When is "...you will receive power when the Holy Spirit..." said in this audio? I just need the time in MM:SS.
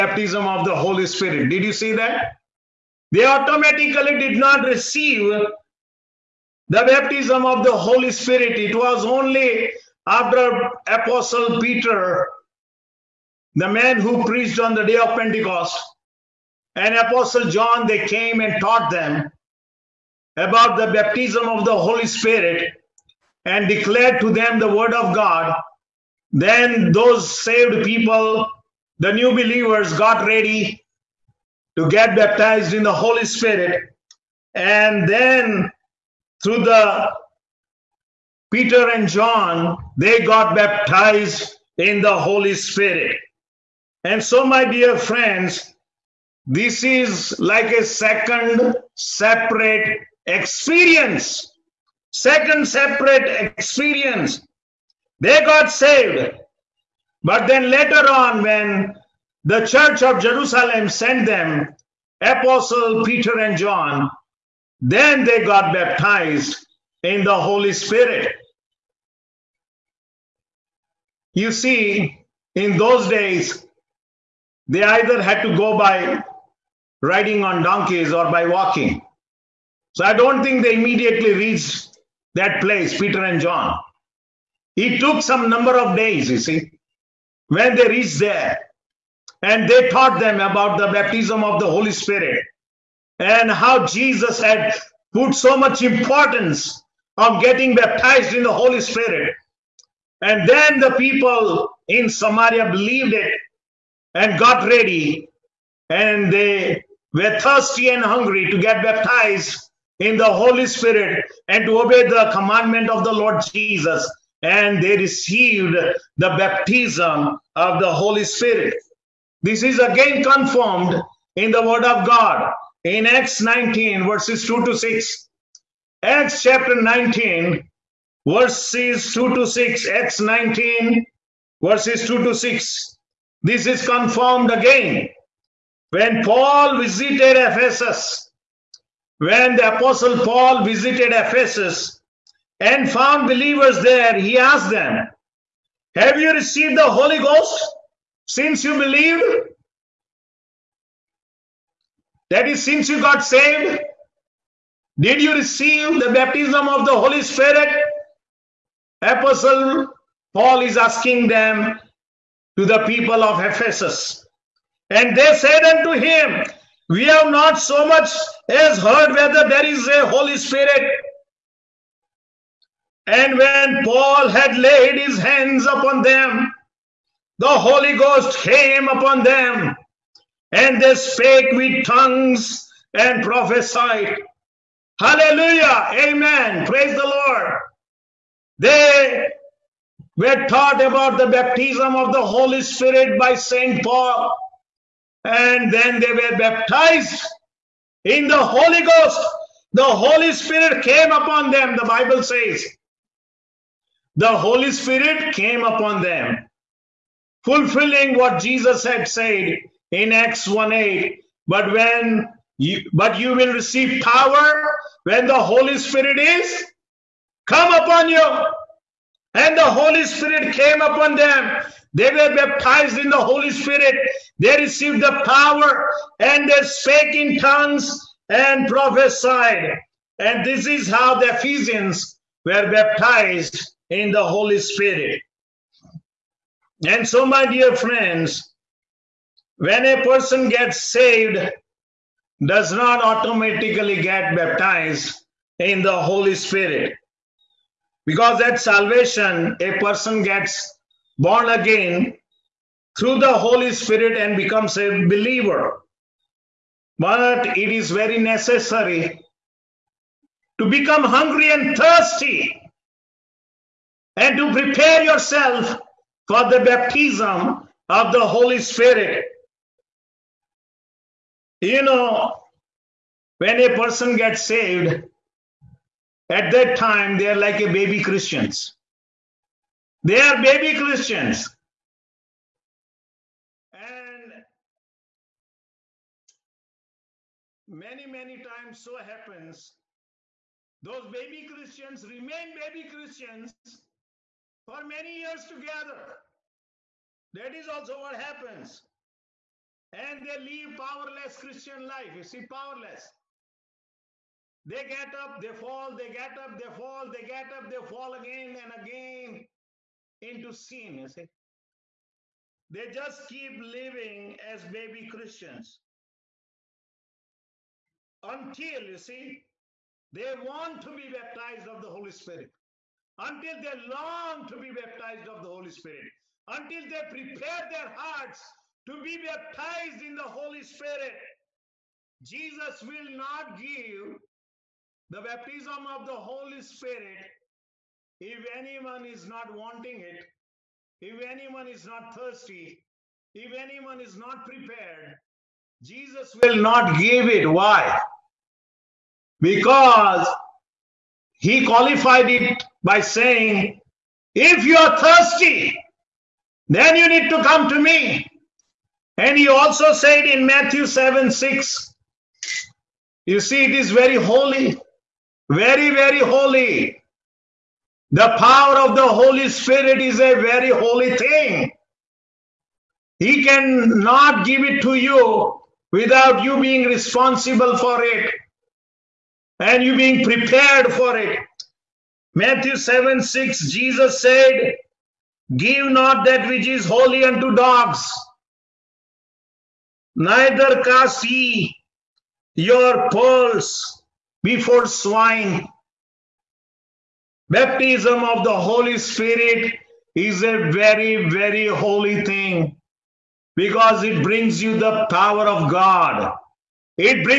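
03:33.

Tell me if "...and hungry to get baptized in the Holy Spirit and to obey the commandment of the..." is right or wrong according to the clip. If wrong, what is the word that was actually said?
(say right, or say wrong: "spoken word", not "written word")
right.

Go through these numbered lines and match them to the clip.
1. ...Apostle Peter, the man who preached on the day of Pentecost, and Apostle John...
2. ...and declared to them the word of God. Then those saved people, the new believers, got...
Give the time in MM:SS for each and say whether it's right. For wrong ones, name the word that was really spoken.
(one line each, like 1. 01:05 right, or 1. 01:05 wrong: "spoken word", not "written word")
1. 00:10 right
2. 00:23 right.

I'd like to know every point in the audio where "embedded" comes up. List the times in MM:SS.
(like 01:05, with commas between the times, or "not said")
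not said.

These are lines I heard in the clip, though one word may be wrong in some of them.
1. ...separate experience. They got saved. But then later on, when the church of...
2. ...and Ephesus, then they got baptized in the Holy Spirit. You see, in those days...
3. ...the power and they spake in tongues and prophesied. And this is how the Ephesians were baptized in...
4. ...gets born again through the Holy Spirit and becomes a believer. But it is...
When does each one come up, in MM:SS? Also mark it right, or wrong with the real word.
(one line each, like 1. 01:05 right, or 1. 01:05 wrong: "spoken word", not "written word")
1. 00:52 right
2. 01:03 wrong: "John", not "Ephesus"
3. 03:45 right
4. 04:10 right.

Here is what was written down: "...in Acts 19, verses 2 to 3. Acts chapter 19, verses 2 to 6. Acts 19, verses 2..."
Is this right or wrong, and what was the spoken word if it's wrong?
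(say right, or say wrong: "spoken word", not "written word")
wrong: "6", not "3".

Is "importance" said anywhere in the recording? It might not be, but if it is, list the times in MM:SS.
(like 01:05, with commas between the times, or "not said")
01:35.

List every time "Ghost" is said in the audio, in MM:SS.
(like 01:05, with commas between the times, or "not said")
02:27, 02:57, 03:18.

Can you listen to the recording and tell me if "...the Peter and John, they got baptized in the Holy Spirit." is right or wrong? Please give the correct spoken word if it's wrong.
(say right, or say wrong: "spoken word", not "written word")
right.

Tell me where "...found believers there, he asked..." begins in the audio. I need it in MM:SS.
02:22.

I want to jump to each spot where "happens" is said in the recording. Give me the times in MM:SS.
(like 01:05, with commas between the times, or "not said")
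04:48, 04:58.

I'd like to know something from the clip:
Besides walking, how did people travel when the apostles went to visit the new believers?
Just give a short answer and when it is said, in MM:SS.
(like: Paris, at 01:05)
Riding on donkeys, at 01:16.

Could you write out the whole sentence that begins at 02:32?
That is, since you got saved, did you receive the baptism of the Holy Spirit?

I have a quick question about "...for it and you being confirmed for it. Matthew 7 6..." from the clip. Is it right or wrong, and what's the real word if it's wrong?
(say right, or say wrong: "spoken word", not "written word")
wrong: "prepared", not "confirmed".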